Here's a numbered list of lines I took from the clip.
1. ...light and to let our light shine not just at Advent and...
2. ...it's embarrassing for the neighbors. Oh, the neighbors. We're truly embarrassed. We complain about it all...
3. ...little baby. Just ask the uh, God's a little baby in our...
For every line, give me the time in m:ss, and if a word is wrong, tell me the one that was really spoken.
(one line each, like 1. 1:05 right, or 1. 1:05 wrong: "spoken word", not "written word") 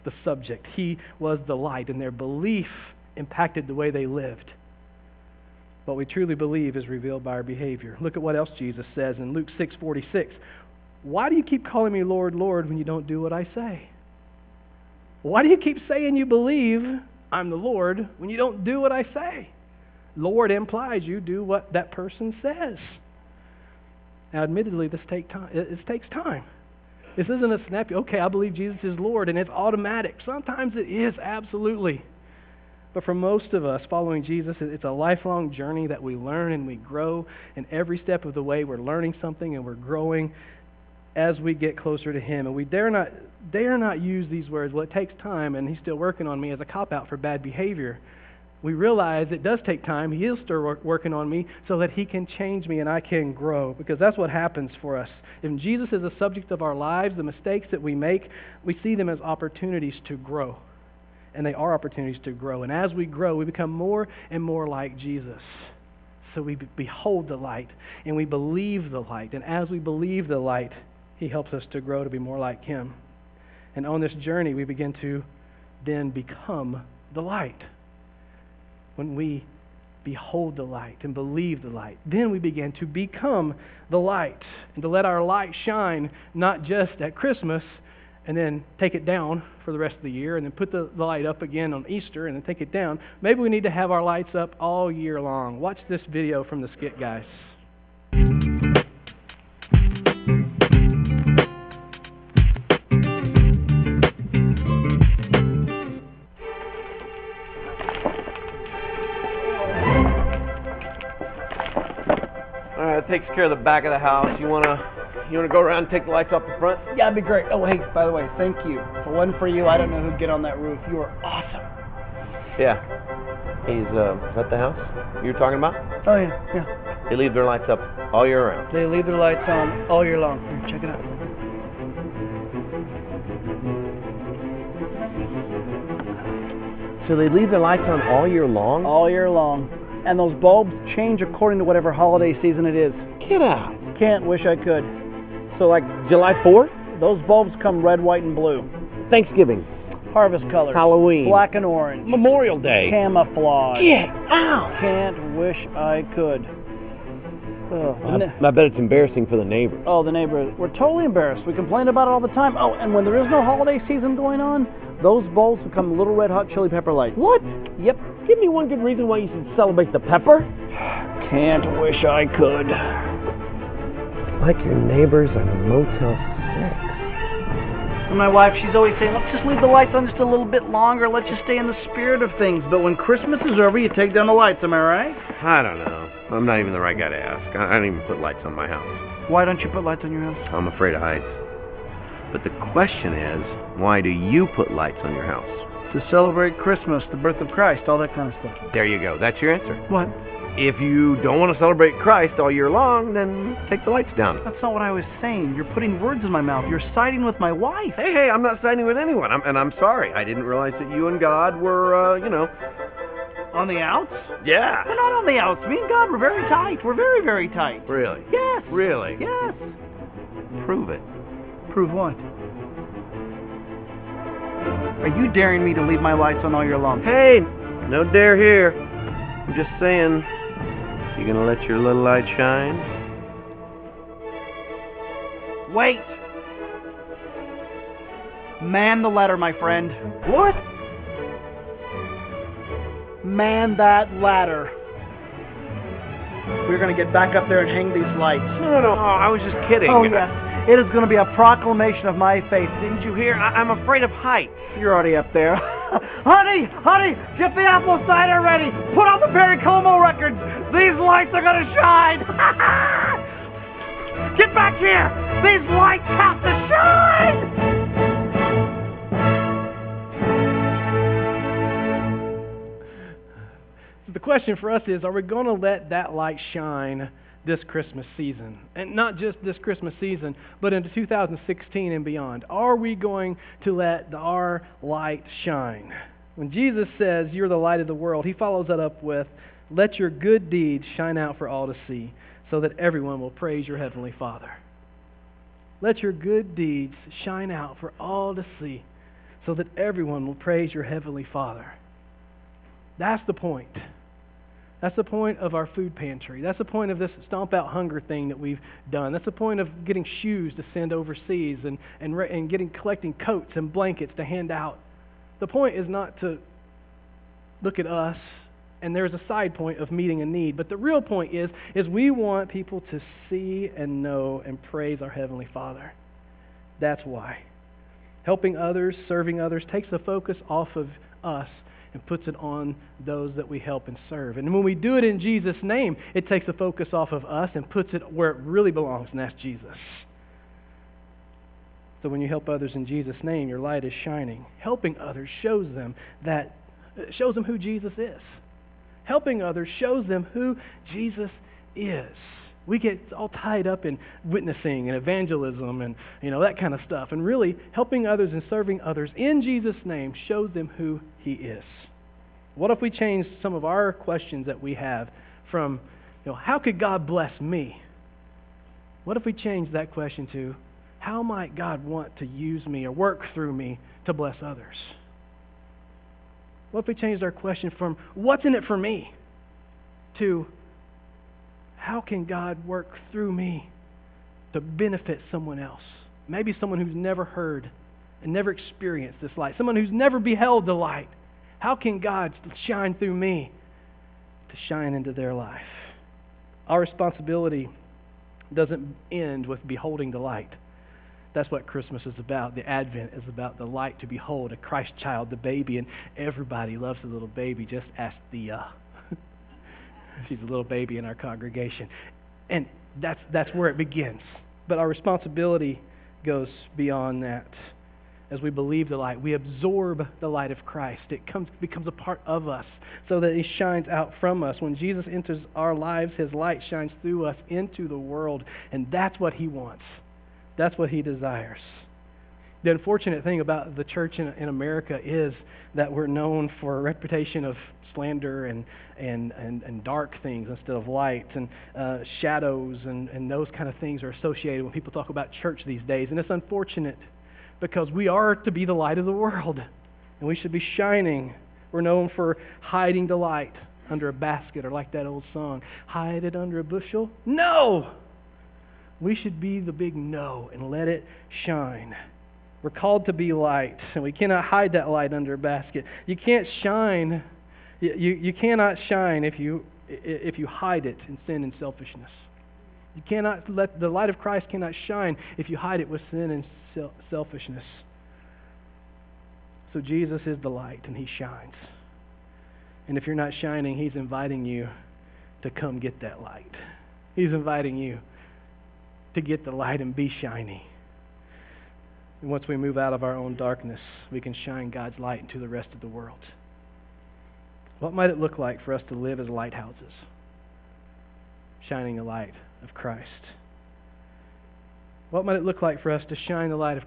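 1. 1:23 wrong: "Christmas", not "Advent"
2. 2:38 wrong: "totally", not "truly"
3. 6:47 wrong: "She", not "God".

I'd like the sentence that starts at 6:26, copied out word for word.
Maybe someone who's never heard and never experienced this light, someone who's never beheld the light.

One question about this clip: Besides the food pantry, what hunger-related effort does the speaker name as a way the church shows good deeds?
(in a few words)
Stomp out hunger.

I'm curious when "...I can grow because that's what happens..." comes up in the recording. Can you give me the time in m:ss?
0:52.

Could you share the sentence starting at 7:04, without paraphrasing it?
When Jesus enters our lives, his light shines through us into the world.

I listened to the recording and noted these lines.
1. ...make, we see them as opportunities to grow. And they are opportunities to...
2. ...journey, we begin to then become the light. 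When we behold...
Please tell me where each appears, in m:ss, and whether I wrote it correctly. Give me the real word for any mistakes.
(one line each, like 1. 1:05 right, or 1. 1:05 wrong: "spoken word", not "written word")
1. 0:57 right
2. 1:14 right.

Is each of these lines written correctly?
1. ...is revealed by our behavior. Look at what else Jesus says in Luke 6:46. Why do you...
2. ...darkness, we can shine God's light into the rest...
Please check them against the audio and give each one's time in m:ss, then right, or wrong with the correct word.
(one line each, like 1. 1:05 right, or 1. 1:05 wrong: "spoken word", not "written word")
1. 0:06 right
2. 8:13 right.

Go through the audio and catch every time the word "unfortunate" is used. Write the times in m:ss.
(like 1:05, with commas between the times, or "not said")
7:12, 7:26.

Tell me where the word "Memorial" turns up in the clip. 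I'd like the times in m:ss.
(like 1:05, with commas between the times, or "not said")
2:32.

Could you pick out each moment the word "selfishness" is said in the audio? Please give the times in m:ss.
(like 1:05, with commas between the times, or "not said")
7:51, 7:57.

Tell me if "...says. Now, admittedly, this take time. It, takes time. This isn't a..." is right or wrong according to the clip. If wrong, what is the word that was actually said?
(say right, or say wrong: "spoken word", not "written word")
right.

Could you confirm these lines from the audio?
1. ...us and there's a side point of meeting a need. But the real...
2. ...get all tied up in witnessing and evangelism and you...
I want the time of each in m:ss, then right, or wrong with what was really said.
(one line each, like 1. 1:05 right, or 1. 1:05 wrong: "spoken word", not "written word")
1. 5:17 right
2. 5:52 right.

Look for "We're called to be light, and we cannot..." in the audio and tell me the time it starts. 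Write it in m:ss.
7:42.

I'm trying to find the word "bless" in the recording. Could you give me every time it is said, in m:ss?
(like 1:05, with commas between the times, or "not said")
6:07, 6:14.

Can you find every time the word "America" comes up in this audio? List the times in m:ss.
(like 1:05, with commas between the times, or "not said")
7:14.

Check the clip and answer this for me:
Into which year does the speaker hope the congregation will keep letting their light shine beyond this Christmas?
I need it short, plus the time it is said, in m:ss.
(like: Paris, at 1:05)
2016, at 4:40.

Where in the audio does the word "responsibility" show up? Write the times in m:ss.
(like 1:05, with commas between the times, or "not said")
6:36, 6:54.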